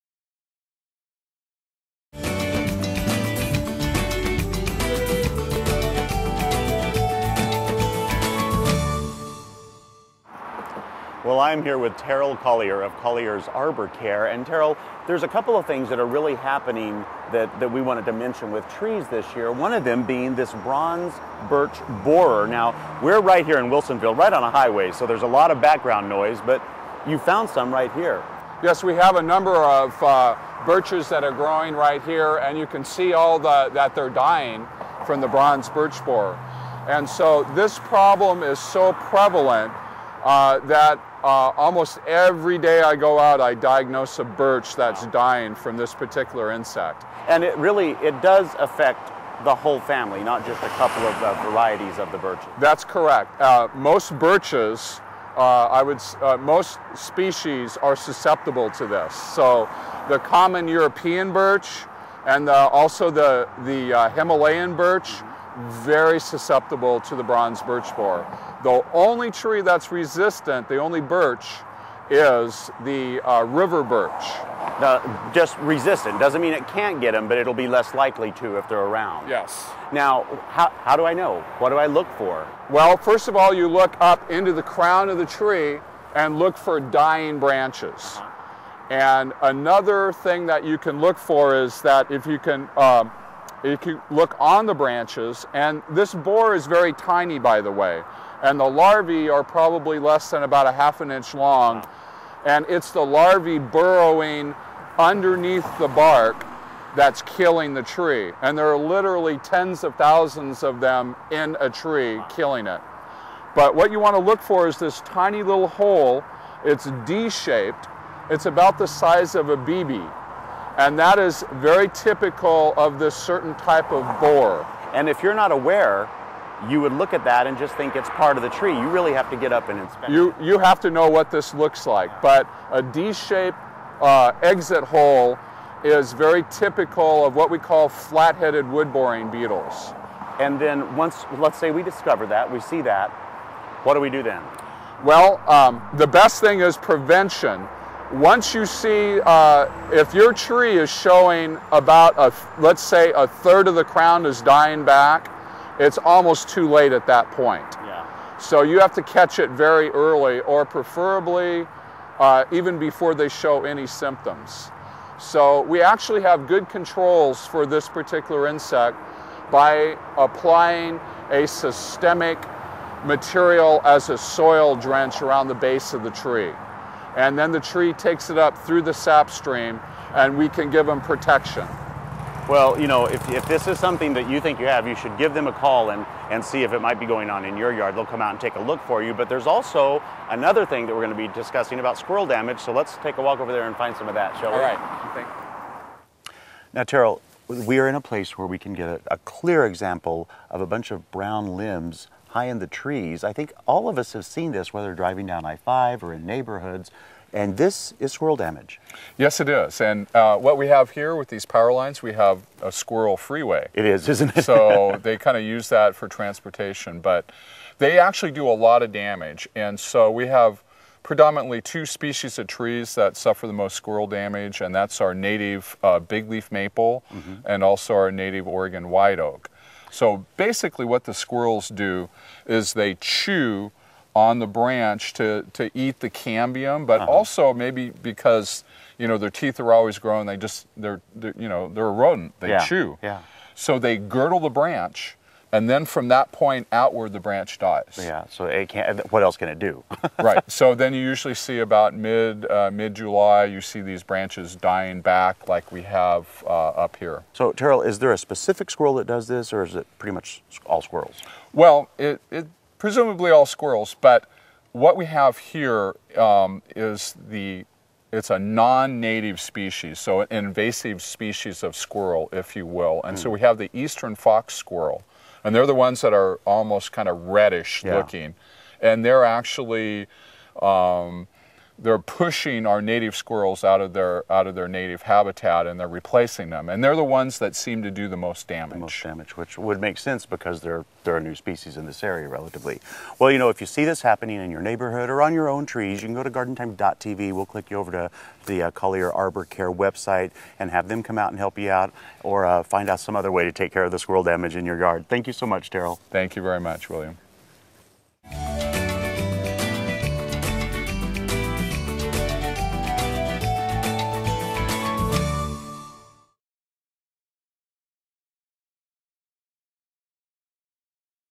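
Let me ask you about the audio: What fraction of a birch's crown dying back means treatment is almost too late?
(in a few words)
A third.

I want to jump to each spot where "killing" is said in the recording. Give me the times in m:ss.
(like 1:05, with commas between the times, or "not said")
1:47, 1:52.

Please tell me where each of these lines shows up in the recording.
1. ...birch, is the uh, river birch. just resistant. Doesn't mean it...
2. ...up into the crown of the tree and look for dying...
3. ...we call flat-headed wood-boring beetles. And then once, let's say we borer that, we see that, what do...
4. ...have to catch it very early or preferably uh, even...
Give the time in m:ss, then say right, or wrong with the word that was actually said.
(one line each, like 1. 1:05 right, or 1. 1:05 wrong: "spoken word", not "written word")
1. 1:11 right
2. 1:23 right
3. 2:17 wrong: "discover", not "borer"
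4. 2:38 right.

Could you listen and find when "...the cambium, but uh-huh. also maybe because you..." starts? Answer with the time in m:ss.
3:55.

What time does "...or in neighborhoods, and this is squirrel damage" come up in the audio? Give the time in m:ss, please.
3:26.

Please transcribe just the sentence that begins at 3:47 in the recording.
and also our native Oregon white oak.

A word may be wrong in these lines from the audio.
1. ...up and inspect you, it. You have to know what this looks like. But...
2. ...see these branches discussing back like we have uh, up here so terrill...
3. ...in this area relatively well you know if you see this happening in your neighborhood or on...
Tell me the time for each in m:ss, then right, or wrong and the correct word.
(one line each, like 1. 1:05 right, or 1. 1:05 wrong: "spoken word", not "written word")
1. 2:09 right
2. 4:13 wrong: "dying", not "discussing"
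3. 4:51 right.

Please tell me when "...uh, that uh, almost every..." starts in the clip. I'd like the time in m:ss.
0:40.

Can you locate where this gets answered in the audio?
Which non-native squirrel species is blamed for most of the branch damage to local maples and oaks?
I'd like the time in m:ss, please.
4:33.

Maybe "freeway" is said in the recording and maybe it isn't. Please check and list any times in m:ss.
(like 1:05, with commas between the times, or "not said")
3:33.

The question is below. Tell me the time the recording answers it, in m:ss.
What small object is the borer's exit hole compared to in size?
1:58.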